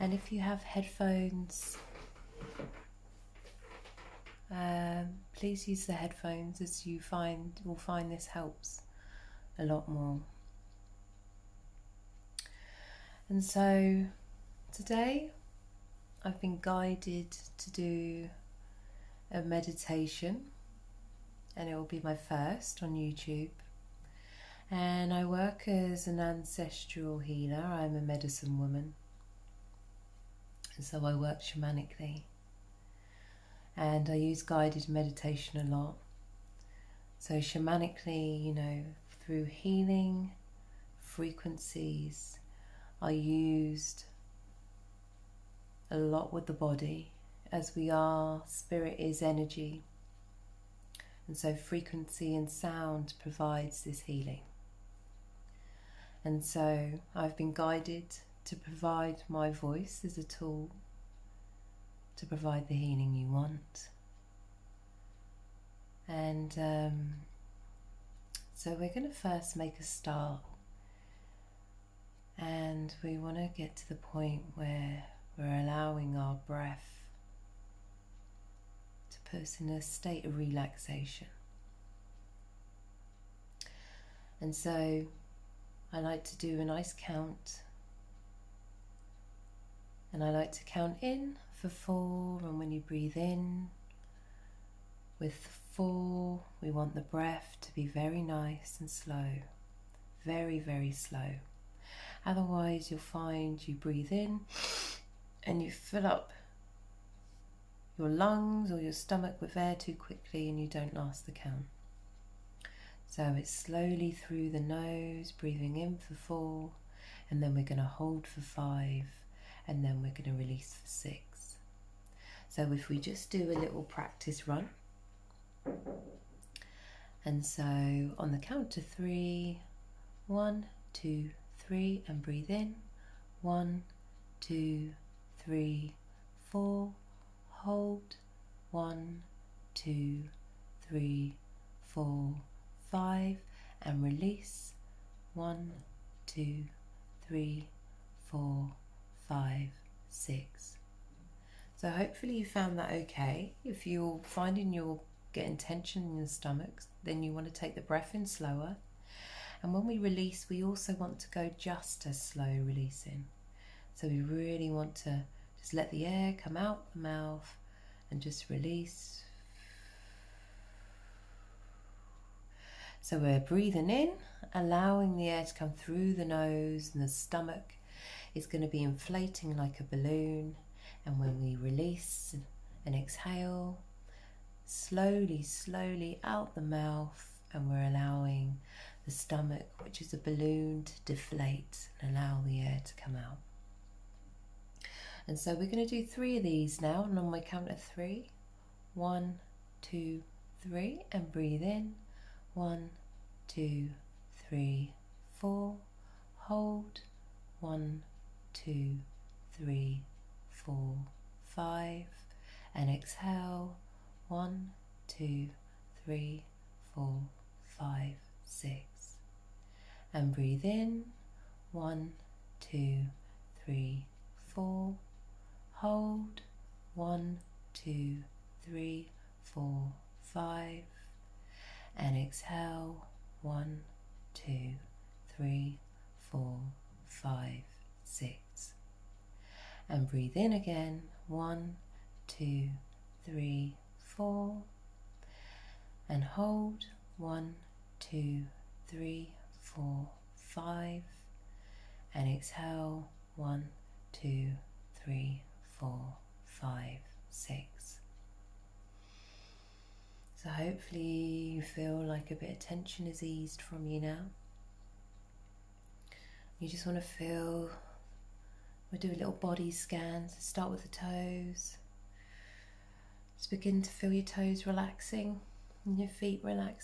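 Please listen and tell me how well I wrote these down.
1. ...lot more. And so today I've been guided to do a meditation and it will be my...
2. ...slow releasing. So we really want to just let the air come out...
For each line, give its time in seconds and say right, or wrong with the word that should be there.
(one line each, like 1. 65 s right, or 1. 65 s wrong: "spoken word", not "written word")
1. 9 s right
2. 162 s right.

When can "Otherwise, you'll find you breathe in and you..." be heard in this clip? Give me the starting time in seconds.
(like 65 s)
102 s.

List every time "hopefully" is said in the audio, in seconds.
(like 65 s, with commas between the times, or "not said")
151 s, 260 s.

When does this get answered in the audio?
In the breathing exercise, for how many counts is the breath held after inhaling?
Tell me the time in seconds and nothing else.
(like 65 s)
117 s.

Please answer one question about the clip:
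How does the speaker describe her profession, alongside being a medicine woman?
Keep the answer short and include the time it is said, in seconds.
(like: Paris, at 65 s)
Ancestral healer, at 26 s.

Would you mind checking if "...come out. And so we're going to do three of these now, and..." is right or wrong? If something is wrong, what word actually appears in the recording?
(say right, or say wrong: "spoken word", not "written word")
right.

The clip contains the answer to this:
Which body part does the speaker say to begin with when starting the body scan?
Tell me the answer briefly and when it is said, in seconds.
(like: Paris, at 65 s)
The toes, at 270 s.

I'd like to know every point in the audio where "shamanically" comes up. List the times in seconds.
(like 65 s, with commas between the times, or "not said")
31 s, 37 s.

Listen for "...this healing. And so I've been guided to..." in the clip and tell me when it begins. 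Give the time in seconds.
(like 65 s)
53 s.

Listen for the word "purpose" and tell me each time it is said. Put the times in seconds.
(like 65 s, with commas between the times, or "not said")
79 s.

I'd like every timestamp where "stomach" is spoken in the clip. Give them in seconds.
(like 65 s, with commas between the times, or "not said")
108 s, 156 s, 177 s, 189 s.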